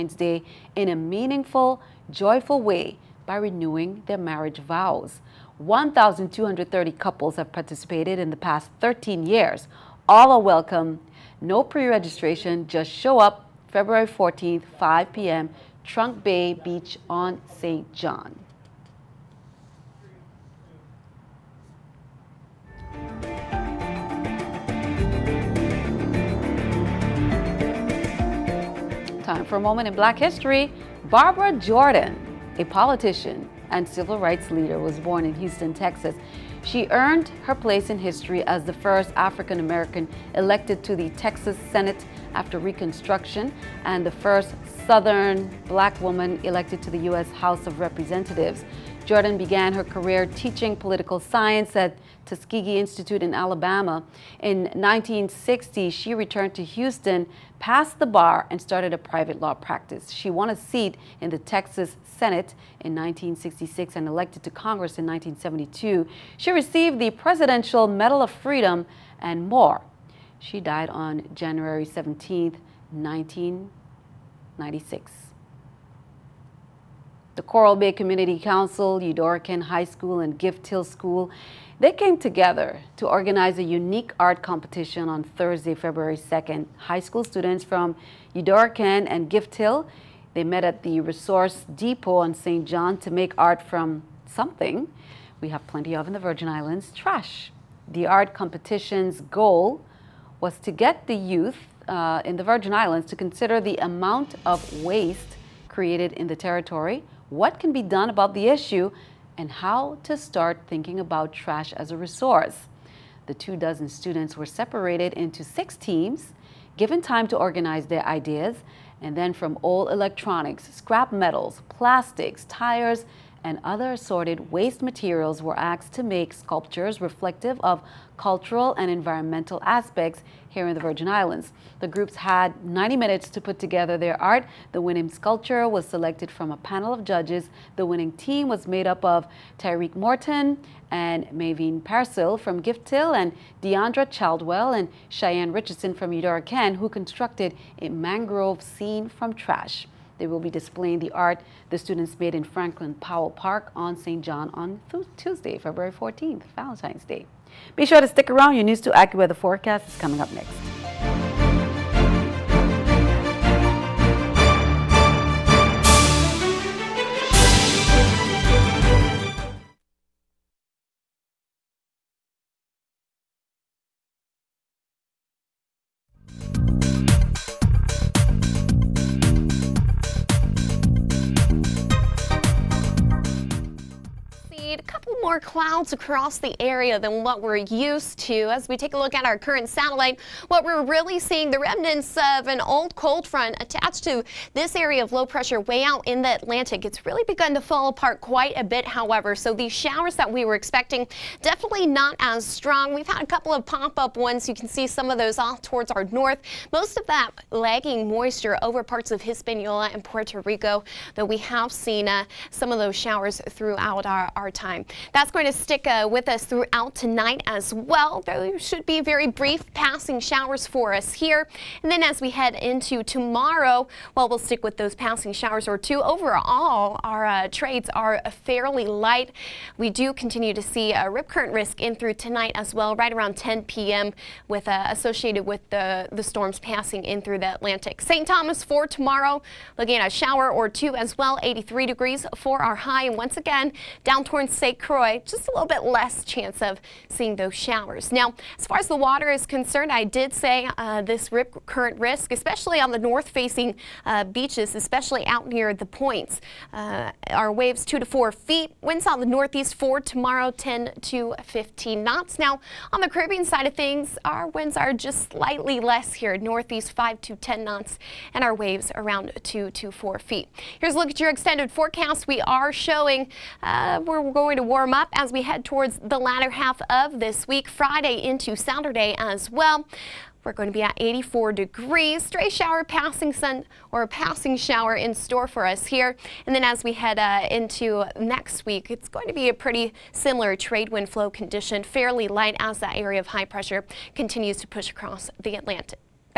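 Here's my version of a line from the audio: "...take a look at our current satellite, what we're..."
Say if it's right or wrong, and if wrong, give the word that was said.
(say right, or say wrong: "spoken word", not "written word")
right.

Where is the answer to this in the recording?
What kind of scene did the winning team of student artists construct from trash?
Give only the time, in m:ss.
2:27.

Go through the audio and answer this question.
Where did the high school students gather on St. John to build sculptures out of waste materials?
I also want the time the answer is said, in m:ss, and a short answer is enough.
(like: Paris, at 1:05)
Resource Depot, at 1:30.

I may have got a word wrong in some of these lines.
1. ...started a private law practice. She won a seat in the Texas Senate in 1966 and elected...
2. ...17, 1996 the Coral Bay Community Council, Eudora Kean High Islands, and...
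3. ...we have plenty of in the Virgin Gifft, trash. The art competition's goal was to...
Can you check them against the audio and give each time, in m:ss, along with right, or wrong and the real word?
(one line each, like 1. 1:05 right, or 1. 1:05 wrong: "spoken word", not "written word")
1. 0:58 right
2. 1:11 wrong: "School", not "Islands"
3. 1:35 wrong: "Islands", not "Gifft".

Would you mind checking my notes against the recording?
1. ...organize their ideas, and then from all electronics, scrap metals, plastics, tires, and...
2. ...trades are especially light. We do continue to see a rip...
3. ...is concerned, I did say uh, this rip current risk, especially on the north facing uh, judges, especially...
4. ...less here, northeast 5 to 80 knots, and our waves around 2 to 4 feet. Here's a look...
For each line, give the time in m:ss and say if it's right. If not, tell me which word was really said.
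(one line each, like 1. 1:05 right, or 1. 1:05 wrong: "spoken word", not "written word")
1. 1:57 right
2. 3:47 wrong: "fairly", not "especially"
3. 4:09 wrong: "beaches", not "judges"
4. 4:25 wrong: "10", not "80".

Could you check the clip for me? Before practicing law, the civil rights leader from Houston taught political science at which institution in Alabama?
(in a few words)
Tuskegee Institute.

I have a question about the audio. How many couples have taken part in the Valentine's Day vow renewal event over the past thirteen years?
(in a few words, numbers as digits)
1,230.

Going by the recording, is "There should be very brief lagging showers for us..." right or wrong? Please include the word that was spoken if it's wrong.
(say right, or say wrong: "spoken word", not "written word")
wrong: "passing", not "lagging".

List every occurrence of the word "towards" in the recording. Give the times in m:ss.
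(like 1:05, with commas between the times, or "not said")
3:25, 4:04, 4:35.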